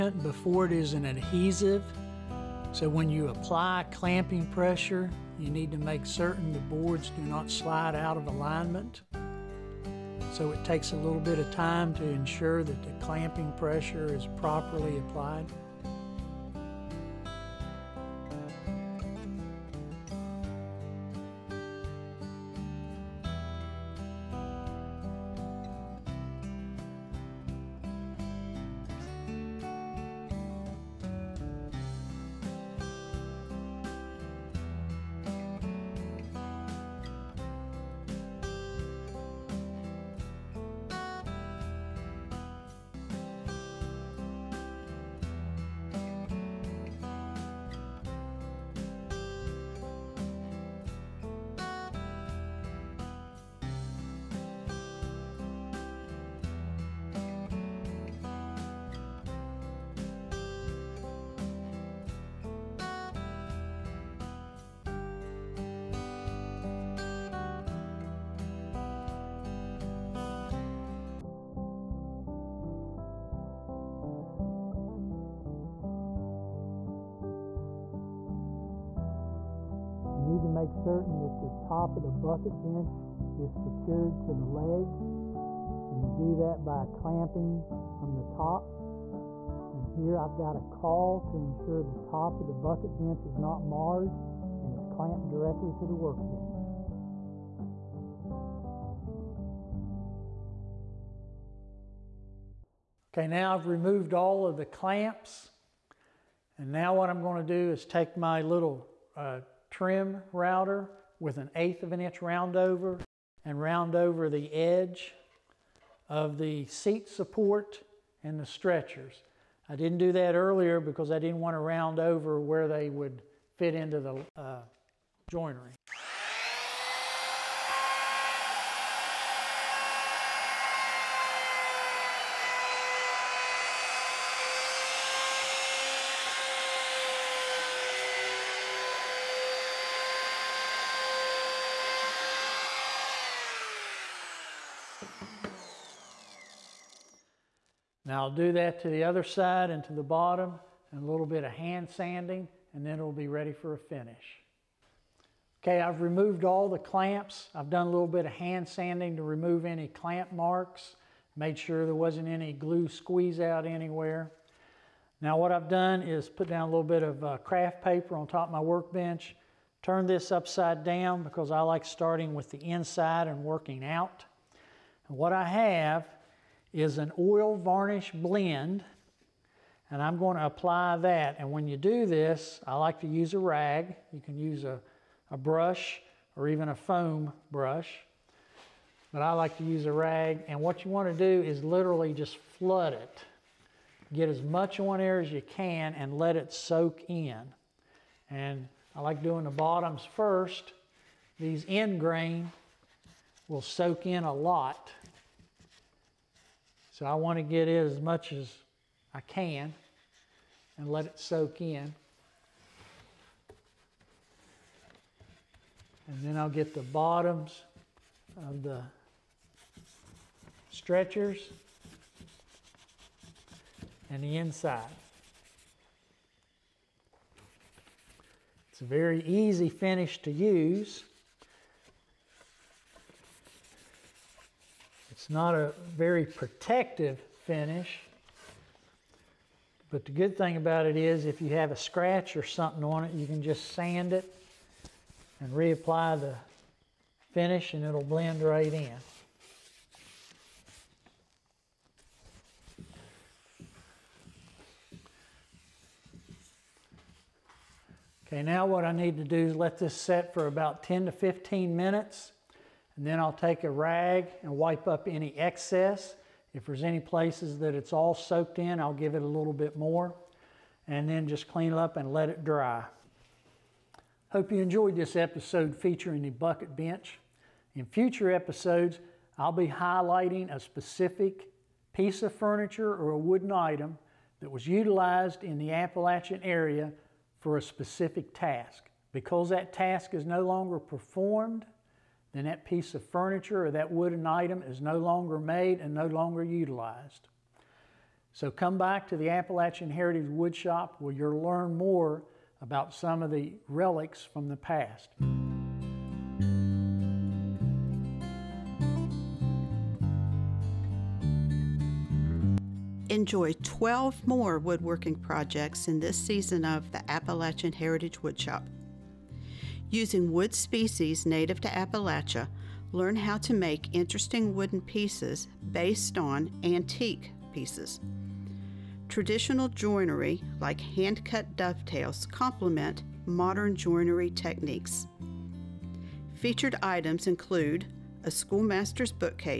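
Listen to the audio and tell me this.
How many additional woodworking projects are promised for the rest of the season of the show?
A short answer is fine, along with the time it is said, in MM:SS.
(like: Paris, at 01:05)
12, at 05:13.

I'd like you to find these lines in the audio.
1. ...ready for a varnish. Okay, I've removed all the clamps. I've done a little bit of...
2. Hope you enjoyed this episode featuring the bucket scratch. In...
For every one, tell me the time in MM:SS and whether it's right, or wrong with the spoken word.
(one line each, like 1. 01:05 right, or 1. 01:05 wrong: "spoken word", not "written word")
1. 02:33 wrong: "finish", not "varnish"
2. 04:34 wrong: "bench", not "scratch".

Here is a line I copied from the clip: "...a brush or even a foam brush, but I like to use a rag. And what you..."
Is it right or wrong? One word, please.
right.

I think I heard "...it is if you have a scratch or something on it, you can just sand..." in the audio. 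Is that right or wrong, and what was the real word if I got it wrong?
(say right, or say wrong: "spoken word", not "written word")
right.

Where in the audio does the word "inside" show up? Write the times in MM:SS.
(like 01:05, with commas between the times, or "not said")
02:52, 03:44.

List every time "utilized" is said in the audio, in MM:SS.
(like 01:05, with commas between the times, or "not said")
04:44, 04:56.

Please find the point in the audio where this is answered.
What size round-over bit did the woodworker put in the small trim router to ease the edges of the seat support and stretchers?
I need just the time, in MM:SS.
01:51.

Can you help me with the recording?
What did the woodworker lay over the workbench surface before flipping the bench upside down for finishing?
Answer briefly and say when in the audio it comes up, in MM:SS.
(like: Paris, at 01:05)
craft paper, at 02:47.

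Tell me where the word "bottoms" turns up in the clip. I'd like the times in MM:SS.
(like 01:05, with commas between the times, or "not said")
02:30, 03:19, 03:36.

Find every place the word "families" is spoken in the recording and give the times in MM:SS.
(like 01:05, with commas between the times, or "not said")
not said.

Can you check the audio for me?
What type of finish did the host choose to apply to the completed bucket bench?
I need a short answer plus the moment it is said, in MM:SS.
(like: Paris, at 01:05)
oil varnish blend, at 02:57.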